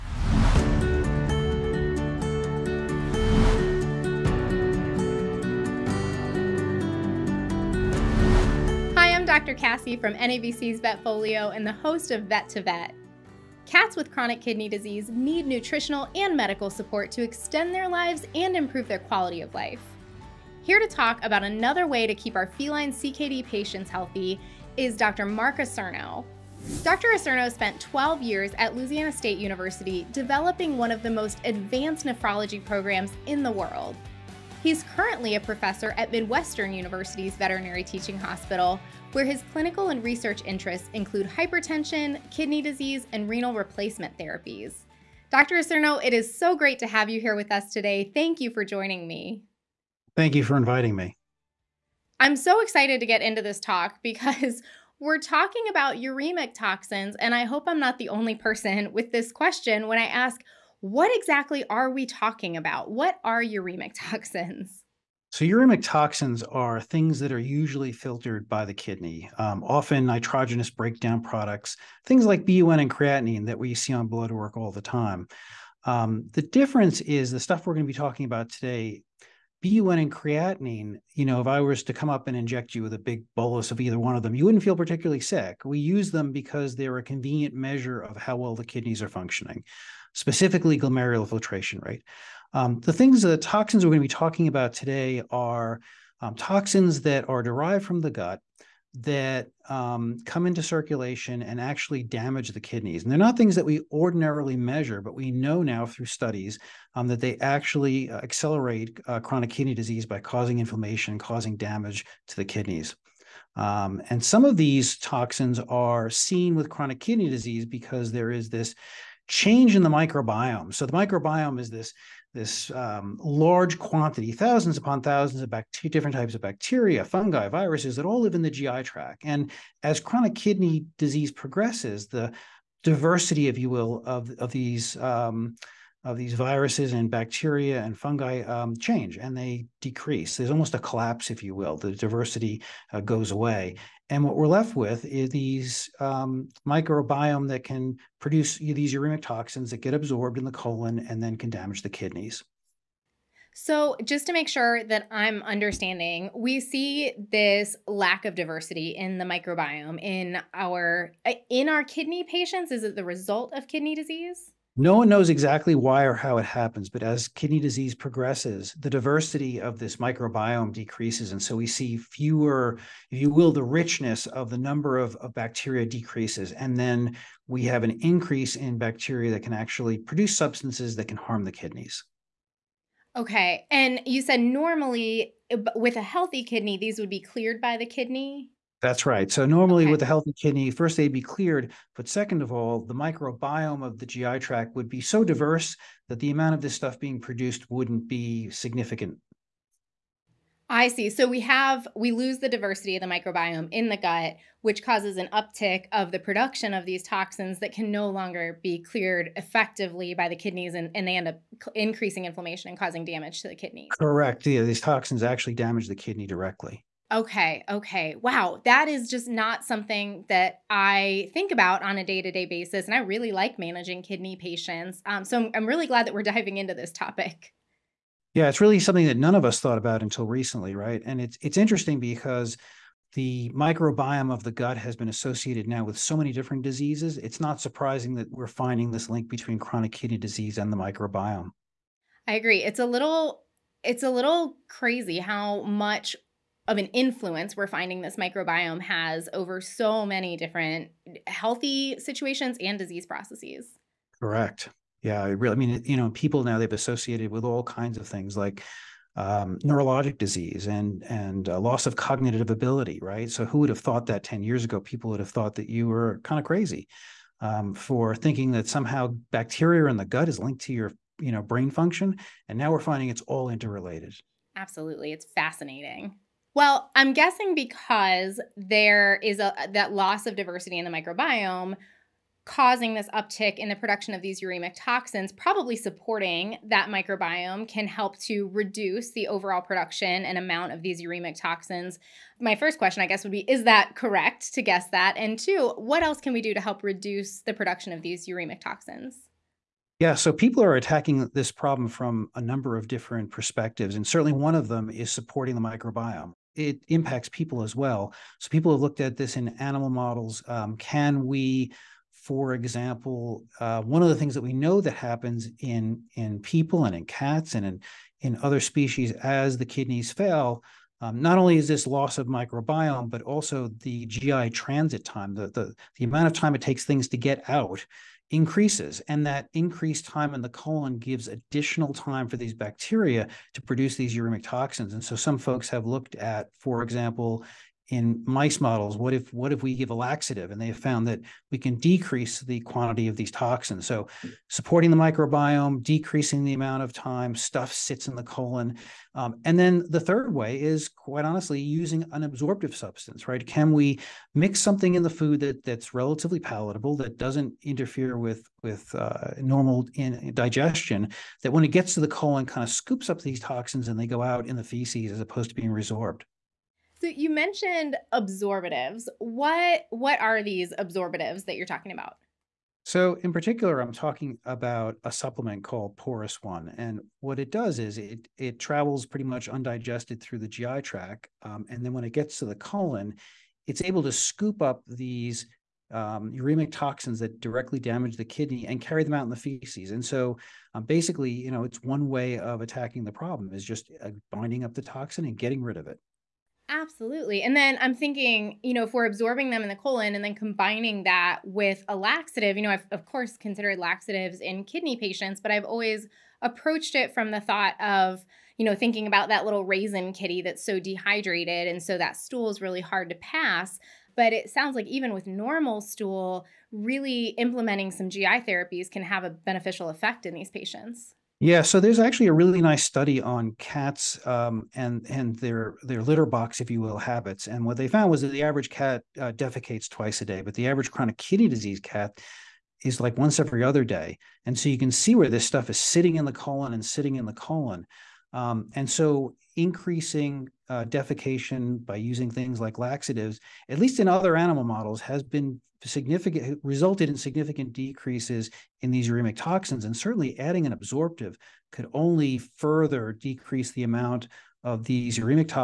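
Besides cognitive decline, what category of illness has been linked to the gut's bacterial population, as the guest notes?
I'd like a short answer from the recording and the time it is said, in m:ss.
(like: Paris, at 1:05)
Neurologic disease, at 4:19.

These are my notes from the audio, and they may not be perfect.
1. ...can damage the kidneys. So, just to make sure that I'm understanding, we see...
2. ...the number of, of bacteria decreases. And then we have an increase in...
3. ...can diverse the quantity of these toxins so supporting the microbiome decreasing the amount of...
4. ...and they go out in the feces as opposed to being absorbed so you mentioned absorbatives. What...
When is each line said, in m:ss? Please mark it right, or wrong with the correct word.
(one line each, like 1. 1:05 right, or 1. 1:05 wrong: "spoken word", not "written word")
1. 2:31 right
2. 2:54 right
3. 5:41 wrong: "decrease", not "diverse"
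4. 6:03 wrong: "resorbed", not "absorbed".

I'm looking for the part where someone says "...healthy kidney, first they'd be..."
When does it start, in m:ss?
3:10.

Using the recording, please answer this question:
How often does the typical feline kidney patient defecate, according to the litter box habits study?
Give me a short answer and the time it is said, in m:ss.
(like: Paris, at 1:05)
Once every other day, at 7:13.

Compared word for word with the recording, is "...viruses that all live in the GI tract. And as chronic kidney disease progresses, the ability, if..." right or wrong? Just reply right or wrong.
wrong.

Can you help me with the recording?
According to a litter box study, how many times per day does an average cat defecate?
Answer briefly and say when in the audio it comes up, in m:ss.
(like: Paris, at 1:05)
Twice a day, at 7:09.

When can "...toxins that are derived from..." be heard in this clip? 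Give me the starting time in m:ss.
1:36.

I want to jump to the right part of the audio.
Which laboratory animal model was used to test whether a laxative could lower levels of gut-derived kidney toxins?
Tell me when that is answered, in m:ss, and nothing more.
5:38.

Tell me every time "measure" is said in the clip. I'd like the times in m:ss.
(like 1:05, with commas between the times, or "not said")
1:27, 1:44.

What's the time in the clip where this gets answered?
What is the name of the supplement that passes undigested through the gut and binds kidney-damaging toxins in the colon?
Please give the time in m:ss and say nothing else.
6:15.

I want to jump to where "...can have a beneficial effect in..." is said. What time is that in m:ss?
6:58.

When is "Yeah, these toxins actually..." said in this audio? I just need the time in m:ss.
3:34.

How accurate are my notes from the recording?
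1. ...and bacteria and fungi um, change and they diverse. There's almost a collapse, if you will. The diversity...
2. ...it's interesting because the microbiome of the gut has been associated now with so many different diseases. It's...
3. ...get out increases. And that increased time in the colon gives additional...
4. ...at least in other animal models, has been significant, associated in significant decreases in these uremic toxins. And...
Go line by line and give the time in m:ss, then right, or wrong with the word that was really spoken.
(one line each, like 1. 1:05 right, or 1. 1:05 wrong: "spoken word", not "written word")
1. 2:16 wrong: "decrease", not "diverse"
2. 3:51 right
3. 5:27 right
4. 7:23 wrong: "resulted", not "associated".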